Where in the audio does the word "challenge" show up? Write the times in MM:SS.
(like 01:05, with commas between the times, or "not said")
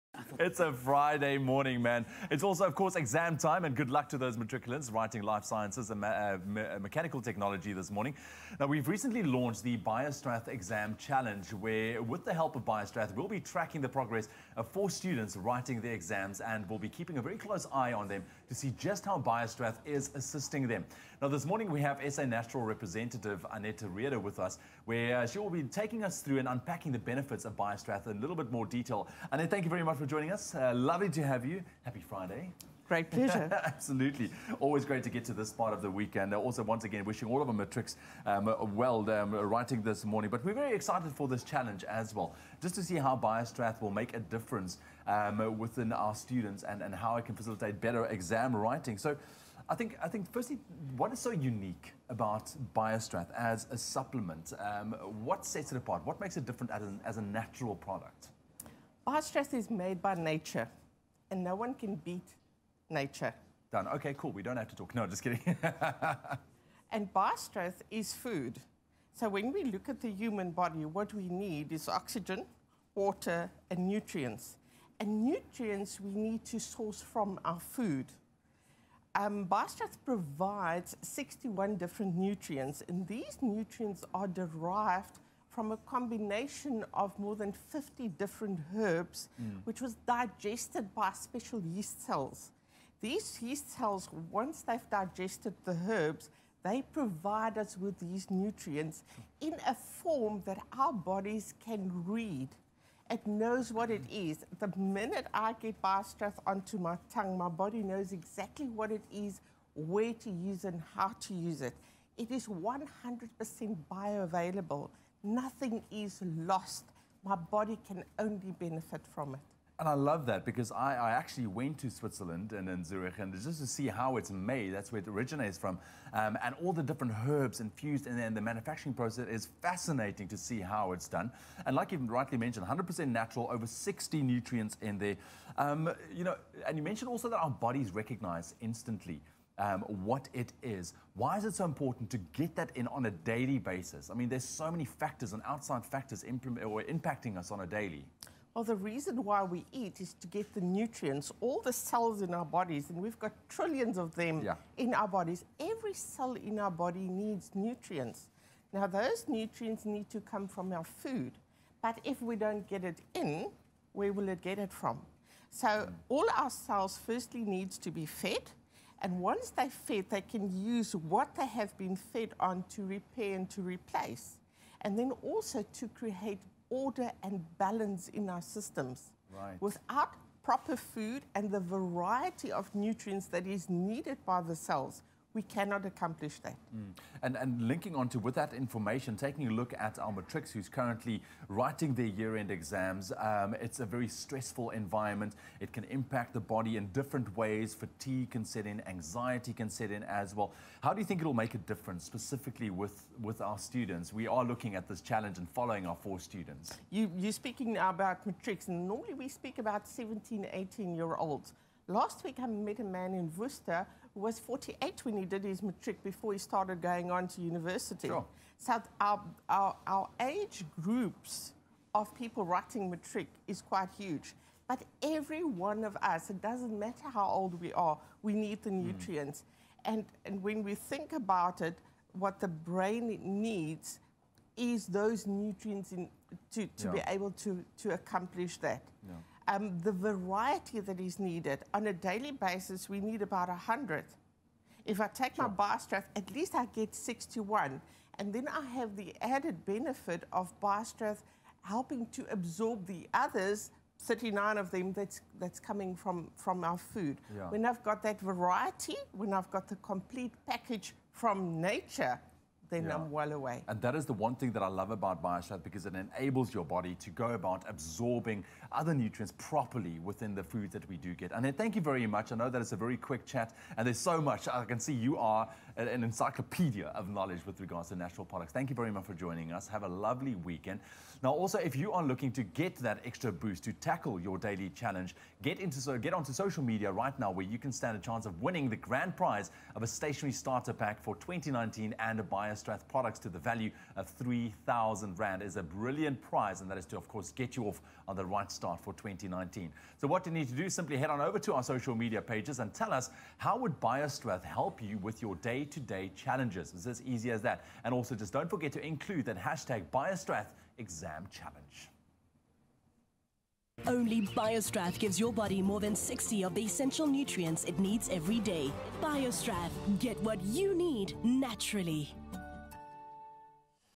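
00:10, 00:41, 03:25, 04:44, 05:06, 05:11.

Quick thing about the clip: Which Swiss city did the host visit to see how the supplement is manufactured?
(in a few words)
Zurich.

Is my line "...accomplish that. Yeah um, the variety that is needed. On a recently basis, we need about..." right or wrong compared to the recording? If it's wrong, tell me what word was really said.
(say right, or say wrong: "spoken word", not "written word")
wrong: "daily", not "recently".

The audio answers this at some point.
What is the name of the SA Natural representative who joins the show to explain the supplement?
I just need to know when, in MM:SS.
00:23.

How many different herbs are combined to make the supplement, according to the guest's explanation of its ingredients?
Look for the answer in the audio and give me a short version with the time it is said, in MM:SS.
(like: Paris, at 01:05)
more than 50, at 01:27.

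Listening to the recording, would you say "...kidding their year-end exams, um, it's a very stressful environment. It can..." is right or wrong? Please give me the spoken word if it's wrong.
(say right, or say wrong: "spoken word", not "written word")
wrong: "writing", not "kidding".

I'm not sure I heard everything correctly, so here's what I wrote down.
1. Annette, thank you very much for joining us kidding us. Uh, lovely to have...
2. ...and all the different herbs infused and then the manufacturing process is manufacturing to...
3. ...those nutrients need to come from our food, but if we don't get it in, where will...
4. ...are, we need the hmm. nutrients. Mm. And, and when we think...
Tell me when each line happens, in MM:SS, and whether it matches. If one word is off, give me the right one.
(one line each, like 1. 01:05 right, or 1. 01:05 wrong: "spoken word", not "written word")
1. 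00:29 wrong: "joining", not "kidding"
2. 02:06 wrong: "fascinating", not "manufacturing"
3. 02:38 right
4. 03:47 right.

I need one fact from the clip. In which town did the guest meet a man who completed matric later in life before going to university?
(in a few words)
Worcester.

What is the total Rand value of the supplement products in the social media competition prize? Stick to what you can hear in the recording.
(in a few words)
3,000 Rand.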